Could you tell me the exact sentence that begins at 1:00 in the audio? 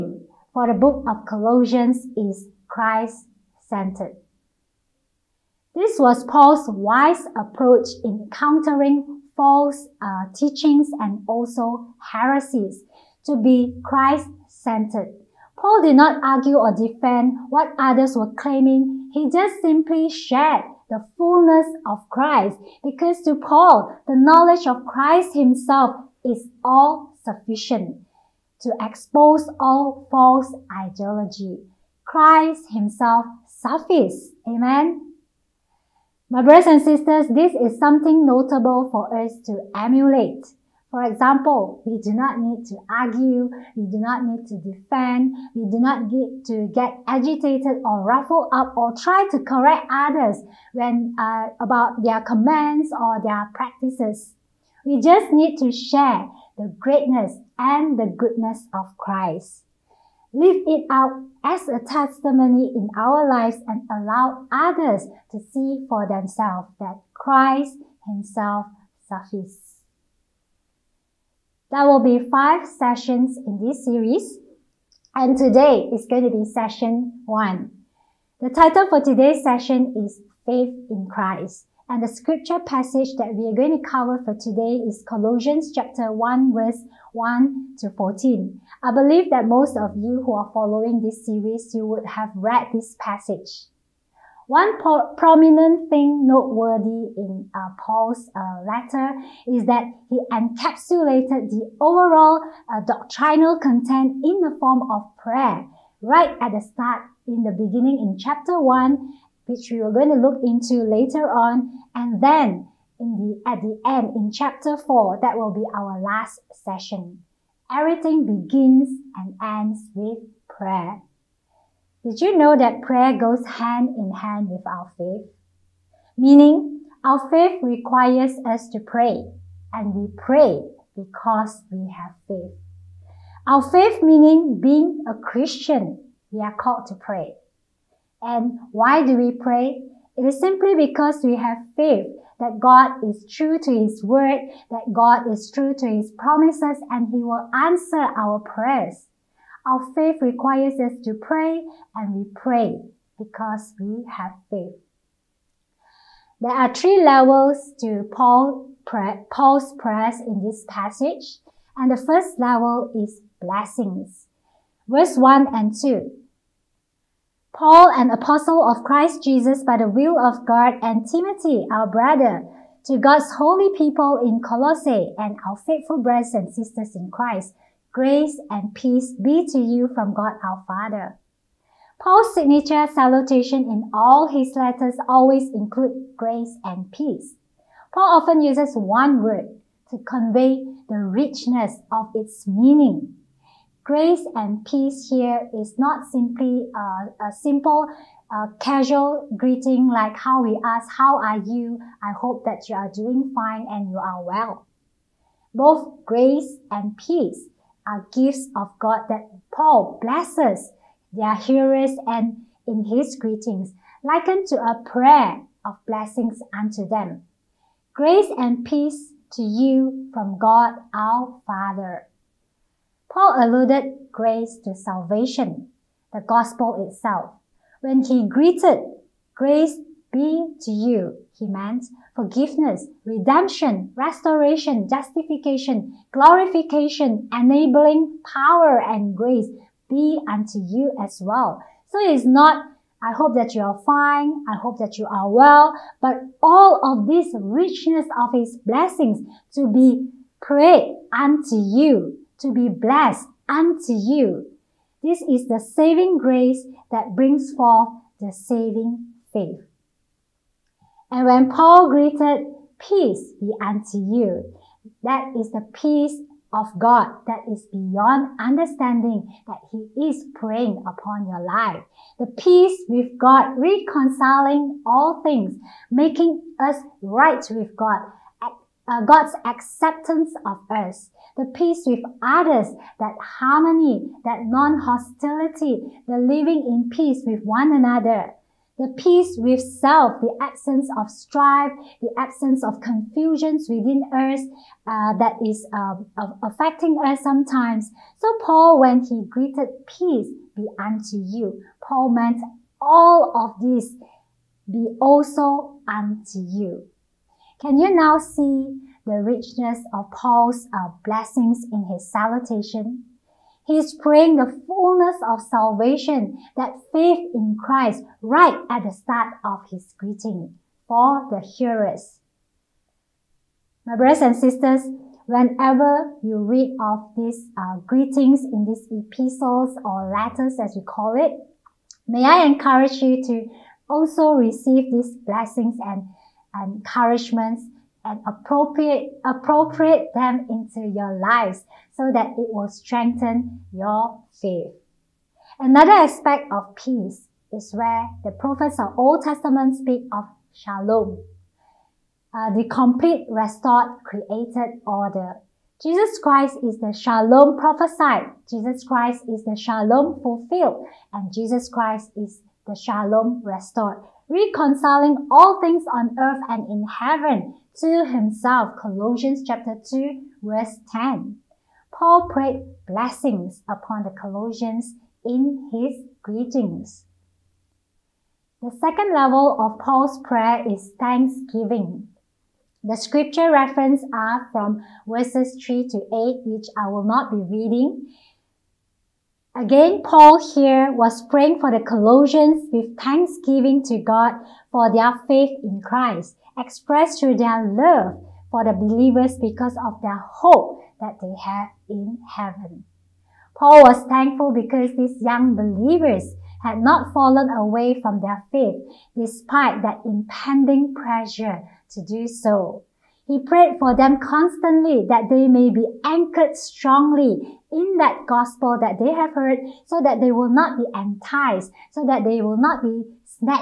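Live it out as a testimony in our lives and allow others to see for themselves that Christ Himself suffices.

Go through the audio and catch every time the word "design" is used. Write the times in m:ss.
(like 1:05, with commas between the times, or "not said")
not said.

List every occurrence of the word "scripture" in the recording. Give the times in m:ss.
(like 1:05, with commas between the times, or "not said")
1:22, 6:22.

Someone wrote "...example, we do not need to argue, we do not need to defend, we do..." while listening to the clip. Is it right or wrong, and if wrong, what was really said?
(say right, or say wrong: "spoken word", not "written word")
right.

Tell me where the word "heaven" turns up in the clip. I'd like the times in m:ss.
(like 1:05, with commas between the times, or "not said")
6:06, 6:42.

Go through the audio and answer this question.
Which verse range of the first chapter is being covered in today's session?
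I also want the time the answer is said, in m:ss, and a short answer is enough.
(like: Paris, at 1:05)
1 to 14, at 1:26.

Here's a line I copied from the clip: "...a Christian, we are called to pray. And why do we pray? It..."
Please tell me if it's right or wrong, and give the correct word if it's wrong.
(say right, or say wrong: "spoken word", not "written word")
right.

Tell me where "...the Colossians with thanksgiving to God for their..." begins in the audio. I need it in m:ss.
6:31.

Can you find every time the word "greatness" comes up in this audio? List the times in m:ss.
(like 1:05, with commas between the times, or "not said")
0:56.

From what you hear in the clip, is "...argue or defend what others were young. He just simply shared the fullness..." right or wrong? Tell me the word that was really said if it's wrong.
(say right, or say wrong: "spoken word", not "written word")
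wrong: "claiming", not "young".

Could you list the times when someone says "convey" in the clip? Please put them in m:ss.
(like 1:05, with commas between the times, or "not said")
3:09.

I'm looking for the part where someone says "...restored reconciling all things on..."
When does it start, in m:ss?
6:03.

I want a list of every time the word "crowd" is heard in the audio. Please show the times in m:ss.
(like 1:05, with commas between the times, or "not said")
not said.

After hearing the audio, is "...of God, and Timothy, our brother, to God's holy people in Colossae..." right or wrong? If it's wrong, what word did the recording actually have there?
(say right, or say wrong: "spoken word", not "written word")
right.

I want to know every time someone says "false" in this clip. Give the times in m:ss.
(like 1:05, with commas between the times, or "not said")
0:09, 0:30.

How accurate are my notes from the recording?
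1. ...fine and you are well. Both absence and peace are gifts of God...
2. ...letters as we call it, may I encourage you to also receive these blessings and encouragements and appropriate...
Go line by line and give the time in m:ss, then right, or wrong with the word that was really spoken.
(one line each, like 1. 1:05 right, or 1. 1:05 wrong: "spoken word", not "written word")
1. 3:23 wrong: "grace", not "absence"
2. 5:30 right.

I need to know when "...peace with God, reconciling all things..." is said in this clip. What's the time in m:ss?
4:32.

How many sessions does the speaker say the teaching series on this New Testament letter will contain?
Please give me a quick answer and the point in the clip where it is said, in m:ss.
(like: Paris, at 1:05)
5, at 1:12.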